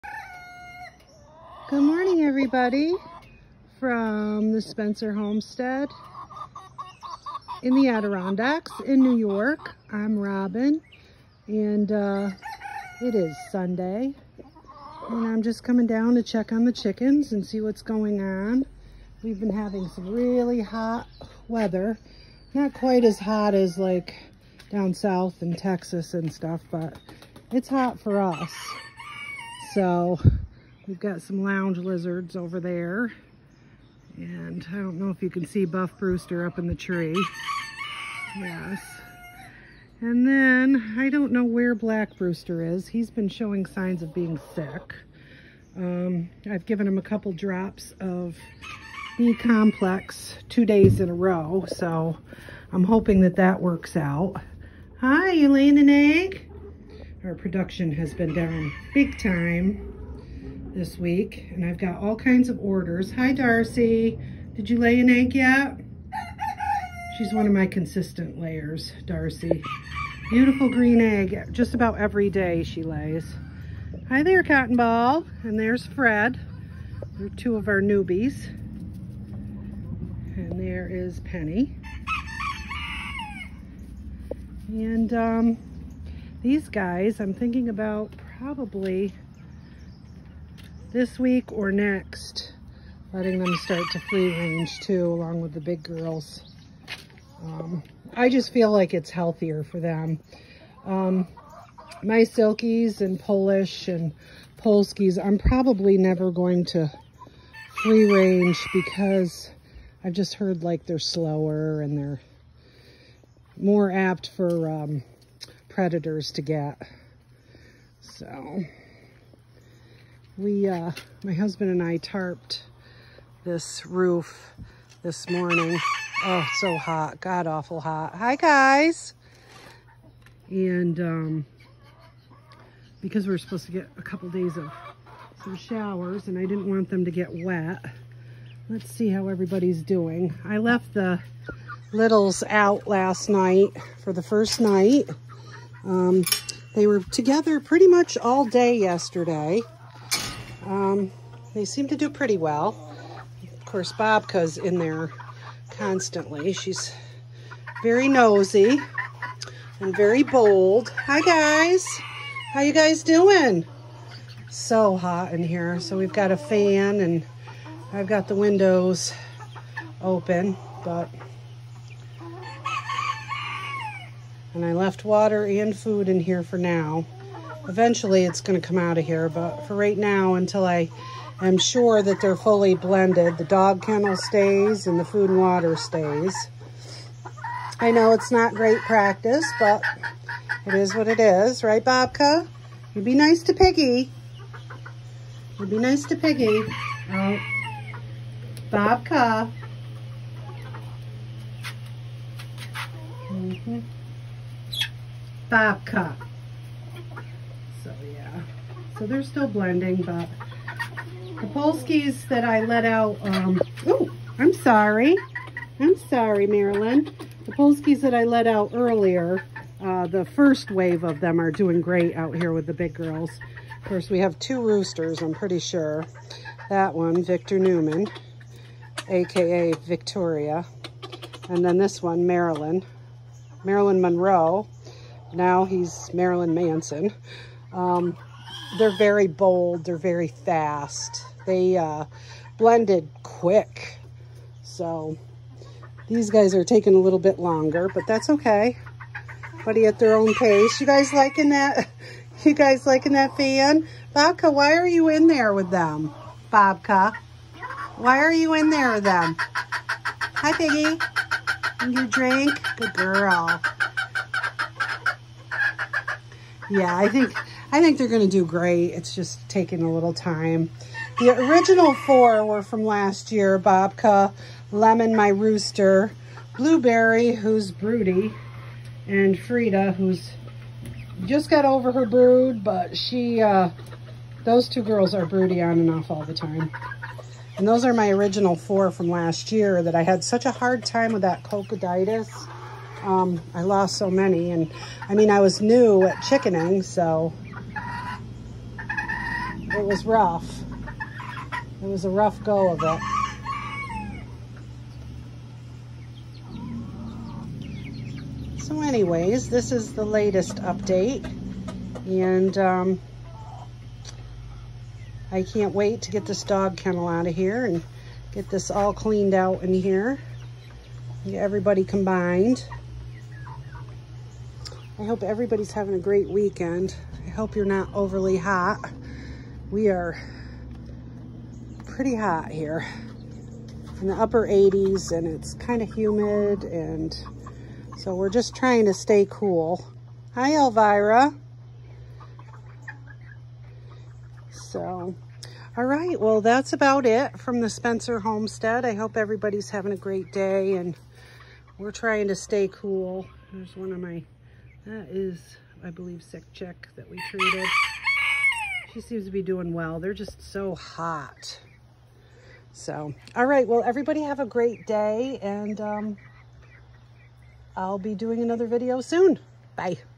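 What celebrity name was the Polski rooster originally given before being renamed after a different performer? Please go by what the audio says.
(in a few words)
Marilyn Monroe.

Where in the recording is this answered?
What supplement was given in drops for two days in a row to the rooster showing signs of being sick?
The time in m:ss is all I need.
0:49.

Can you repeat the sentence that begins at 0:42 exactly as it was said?
He's been showing signs of being sick.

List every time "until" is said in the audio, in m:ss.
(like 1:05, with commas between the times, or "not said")
3:00.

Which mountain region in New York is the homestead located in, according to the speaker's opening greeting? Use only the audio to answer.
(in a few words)
Adirondacks.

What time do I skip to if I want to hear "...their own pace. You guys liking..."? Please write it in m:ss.
4:09.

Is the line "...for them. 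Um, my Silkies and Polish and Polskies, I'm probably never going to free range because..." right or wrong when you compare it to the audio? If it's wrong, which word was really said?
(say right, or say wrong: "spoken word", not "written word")
right.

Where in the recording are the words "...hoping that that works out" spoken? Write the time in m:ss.
0:52.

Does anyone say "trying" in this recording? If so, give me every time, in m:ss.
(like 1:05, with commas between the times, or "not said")
5:38, 5:51.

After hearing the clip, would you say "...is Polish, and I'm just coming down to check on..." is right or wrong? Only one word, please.
wrong.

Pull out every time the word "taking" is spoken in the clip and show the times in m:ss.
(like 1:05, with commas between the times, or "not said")
4:06, 4:29.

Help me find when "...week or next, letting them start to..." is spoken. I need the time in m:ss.
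1:31.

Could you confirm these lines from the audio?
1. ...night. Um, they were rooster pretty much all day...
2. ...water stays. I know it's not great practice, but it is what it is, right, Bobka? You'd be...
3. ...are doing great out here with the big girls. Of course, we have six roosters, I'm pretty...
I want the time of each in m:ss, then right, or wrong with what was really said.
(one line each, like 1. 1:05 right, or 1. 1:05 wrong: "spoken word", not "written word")
1. 2:24 wrong: "together", not "rooster"
2. 3:05 right
3. 3:41 wrong: "two", not "six".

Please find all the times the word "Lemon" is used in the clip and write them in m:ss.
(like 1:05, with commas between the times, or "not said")
4:34.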